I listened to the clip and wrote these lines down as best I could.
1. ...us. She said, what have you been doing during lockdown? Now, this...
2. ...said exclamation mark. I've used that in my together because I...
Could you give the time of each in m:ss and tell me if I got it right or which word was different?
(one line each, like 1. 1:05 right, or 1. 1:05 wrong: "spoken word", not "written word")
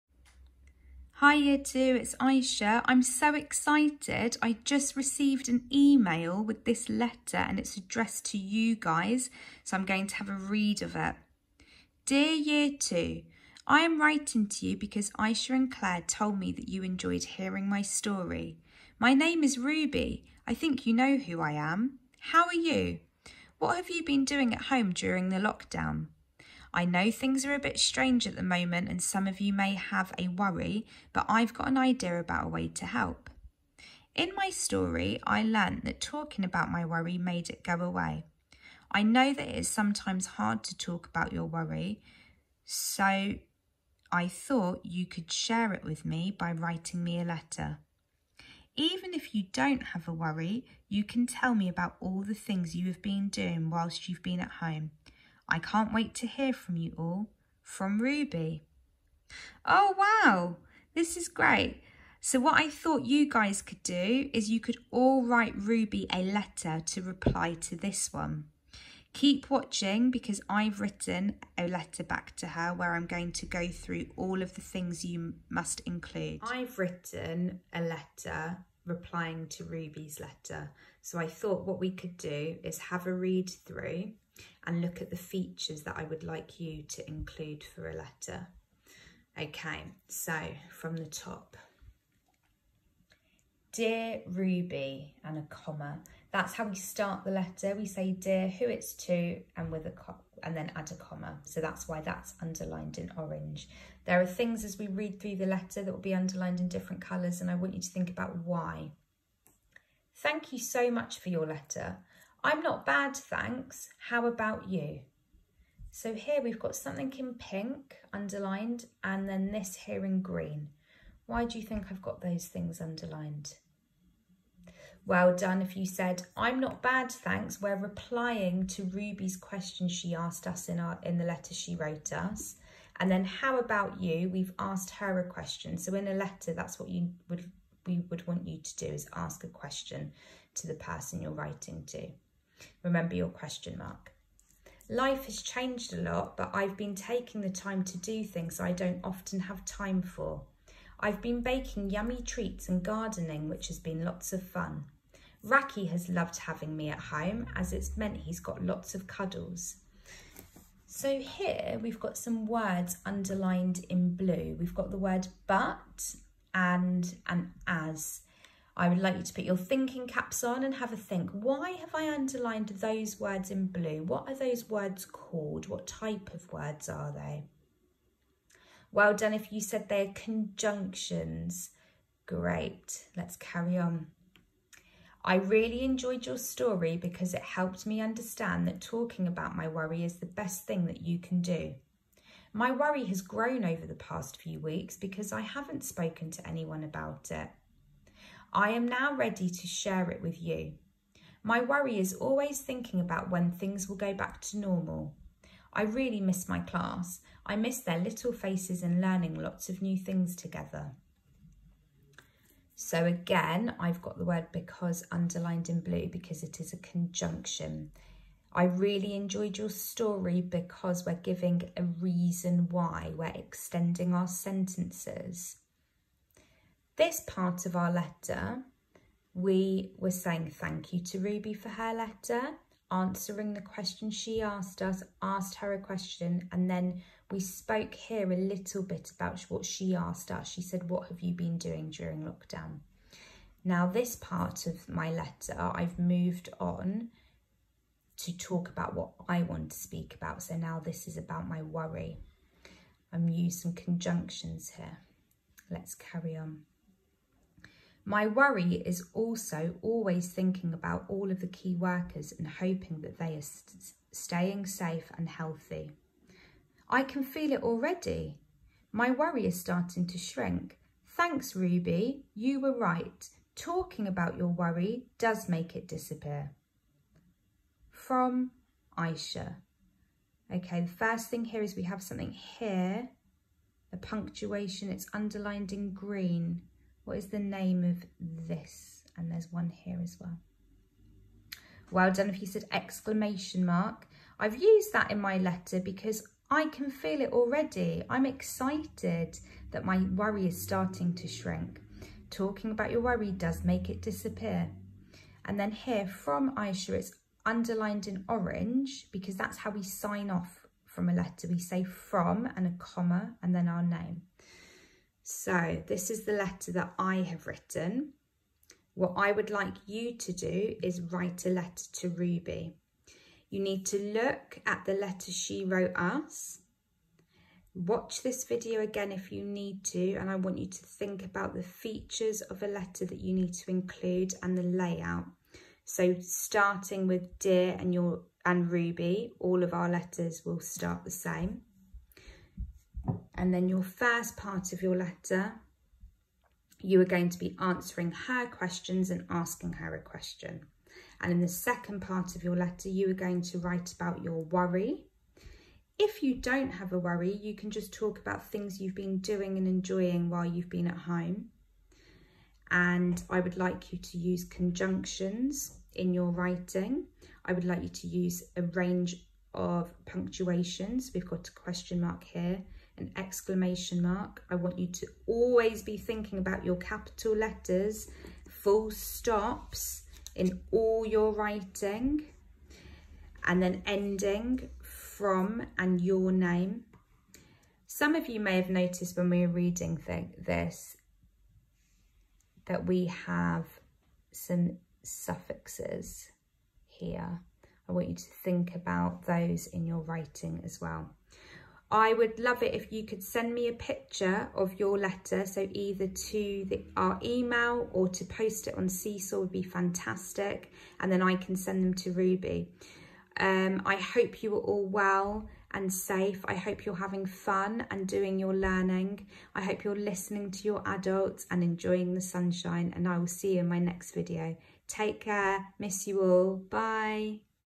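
1. 4:00 right
2. 4:52 wrong: "letter", not "together".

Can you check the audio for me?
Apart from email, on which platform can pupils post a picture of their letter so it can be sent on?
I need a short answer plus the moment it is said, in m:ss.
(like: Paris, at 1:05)
Seesaw, at 6:48.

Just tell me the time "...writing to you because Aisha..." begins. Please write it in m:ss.
0:14.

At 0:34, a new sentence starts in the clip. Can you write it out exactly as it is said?
In my story, I learnt that talking about my worry made it go away.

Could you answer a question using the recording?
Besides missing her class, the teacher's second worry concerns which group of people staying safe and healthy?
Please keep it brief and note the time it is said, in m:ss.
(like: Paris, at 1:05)
Key workers, at 4:21.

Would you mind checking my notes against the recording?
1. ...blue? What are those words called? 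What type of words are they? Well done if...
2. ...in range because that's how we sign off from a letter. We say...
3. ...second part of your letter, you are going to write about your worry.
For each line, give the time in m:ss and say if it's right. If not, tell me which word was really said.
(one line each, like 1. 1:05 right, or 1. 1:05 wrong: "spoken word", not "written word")
1. 2:53 right
2. 5:08 wrong: "orange", not "range"
3. 5:51 right.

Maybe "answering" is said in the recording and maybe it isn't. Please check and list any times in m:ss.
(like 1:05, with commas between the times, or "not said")
3:52, 5:47.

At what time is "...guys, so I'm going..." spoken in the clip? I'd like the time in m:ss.
0:08.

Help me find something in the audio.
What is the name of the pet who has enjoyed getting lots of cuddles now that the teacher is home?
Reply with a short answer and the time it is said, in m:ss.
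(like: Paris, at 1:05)
Raki, at 2:35.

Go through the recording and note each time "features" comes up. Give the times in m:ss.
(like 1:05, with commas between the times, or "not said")
1:25, 5:31.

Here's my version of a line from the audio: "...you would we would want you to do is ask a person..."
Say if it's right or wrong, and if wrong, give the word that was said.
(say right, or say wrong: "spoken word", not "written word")
wrong: "question", not "person".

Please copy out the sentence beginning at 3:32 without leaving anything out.
So again, I've got the word because underlined in blue because it is a conjunction.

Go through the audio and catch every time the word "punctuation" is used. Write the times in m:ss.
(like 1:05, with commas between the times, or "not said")
4:43, 6:10.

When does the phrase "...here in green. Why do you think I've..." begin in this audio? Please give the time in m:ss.
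1:59.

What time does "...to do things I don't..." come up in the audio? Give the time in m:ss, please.
2:27.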